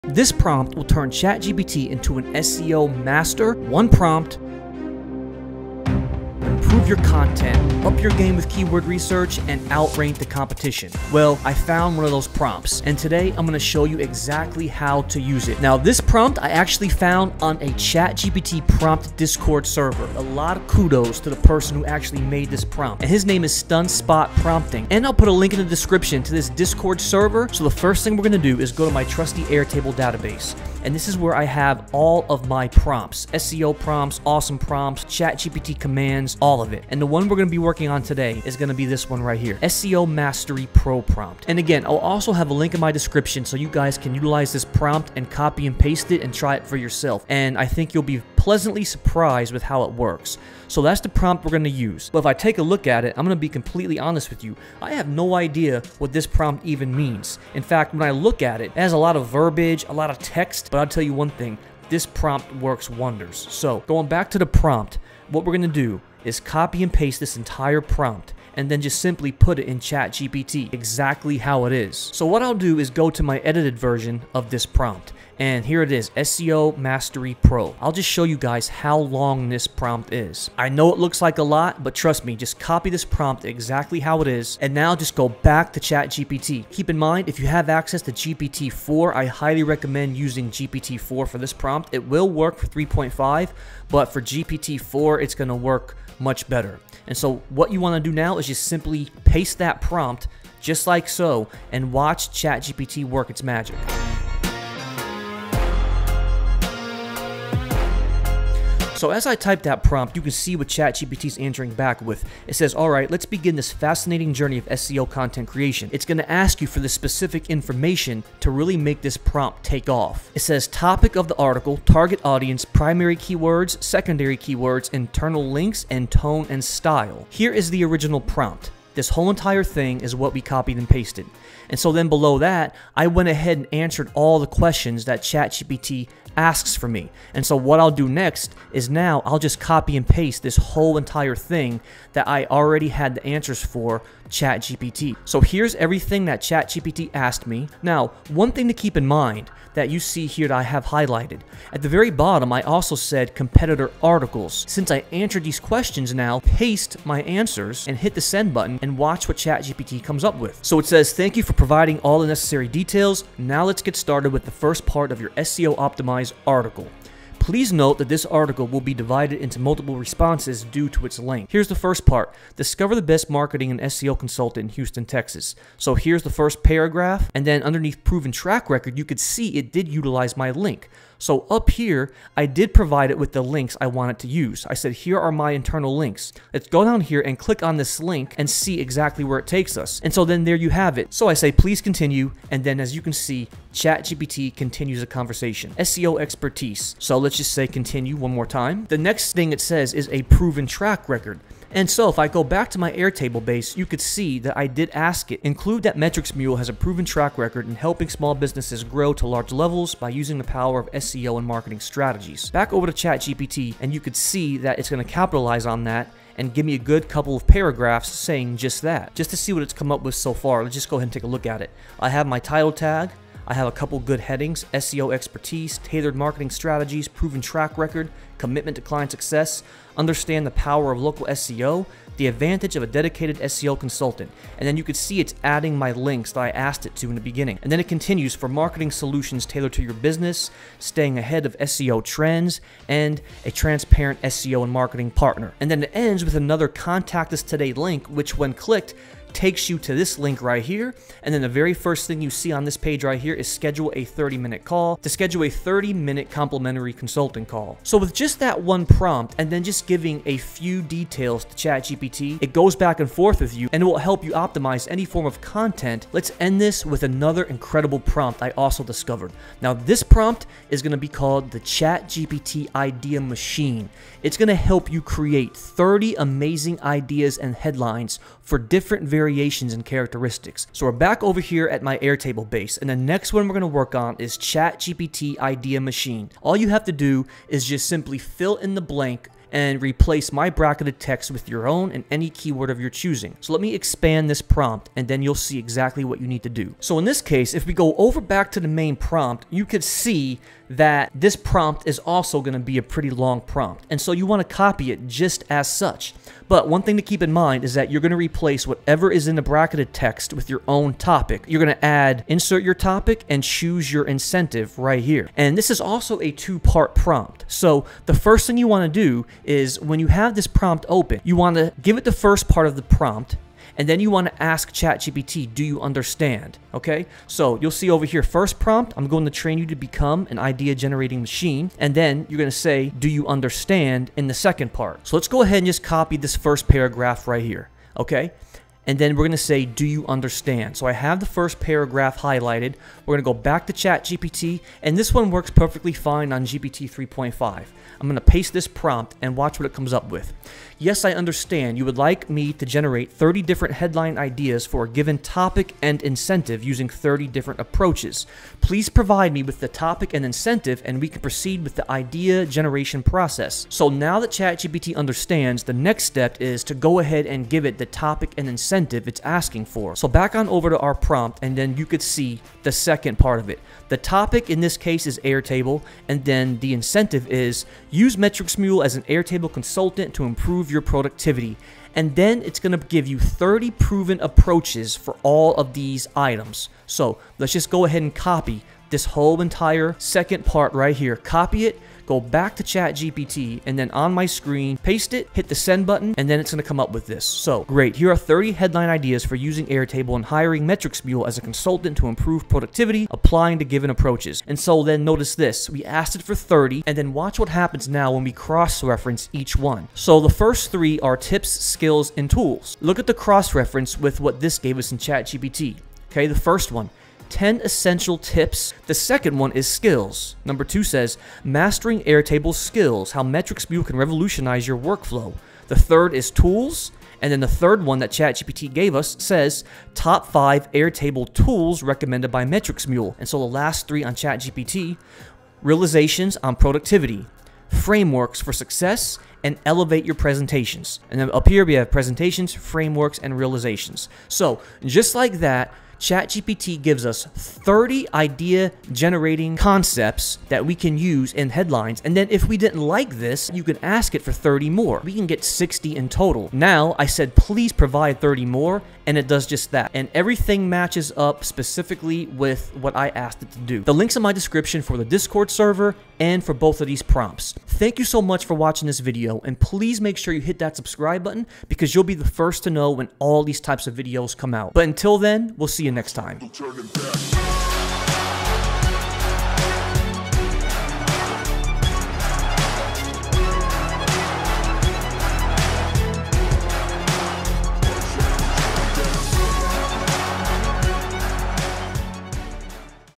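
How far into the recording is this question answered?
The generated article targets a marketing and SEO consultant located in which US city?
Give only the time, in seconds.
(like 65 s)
174 s.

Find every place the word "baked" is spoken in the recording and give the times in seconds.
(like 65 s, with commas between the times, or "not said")
not said.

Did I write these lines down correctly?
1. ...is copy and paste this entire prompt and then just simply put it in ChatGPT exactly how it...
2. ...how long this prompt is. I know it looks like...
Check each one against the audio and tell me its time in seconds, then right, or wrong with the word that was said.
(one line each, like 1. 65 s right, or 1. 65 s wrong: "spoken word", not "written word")
1. 66 s right
2. 78 s right.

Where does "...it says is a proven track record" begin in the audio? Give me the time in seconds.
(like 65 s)
199 s.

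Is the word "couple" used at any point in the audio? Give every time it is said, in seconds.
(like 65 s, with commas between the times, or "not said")
217 s, 223 s.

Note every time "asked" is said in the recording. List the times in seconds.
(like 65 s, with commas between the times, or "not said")
147 s, 236 s, 405 s, 463 s.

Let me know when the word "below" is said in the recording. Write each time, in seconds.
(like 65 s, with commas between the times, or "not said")
132 s.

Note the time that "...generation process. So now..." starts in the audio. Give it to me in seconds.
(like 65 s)
362 s.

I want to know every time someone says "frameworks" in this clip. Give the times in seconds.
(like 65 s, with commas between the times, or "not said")
437 s, 442 s.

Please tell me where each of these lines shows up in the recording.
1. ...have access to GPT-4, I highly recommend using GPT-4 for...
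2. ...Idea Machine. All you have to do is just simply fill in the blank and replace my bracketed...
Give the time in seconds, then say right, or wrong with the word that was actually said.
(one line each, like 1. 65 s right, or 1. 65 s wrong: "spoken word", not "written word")
1. 87 s right
2. 285 s right.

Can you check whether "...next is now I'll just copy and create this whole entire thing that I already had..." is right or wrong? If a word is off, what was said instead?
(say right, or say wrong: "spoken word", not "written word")
wrong: "paste", not "create".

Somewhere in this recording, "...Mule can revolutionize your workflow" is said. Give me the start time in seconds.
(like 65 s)
423 s.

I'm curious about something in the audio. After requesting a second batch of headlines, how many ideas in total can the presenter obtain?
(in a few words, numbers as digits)
60.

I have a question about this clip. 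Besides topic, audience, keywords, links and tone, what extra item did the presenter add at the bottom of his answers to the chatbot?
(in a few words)
competitor articles.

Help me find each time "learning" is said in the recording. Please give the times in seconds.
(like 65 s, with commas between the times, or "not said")
not said.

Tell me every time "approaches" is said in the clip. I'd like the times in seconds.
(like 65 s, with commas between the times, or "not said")
357 s, 384 s, 403 s.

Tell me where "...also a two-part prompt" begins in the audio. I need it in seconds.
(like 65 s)
315 s.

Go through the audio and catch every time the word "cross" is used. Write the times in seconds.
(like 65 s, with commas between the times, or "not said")
408 s, 413 s.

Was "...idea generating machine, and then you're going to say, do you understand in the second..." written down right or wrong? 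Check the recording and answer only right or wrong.
right.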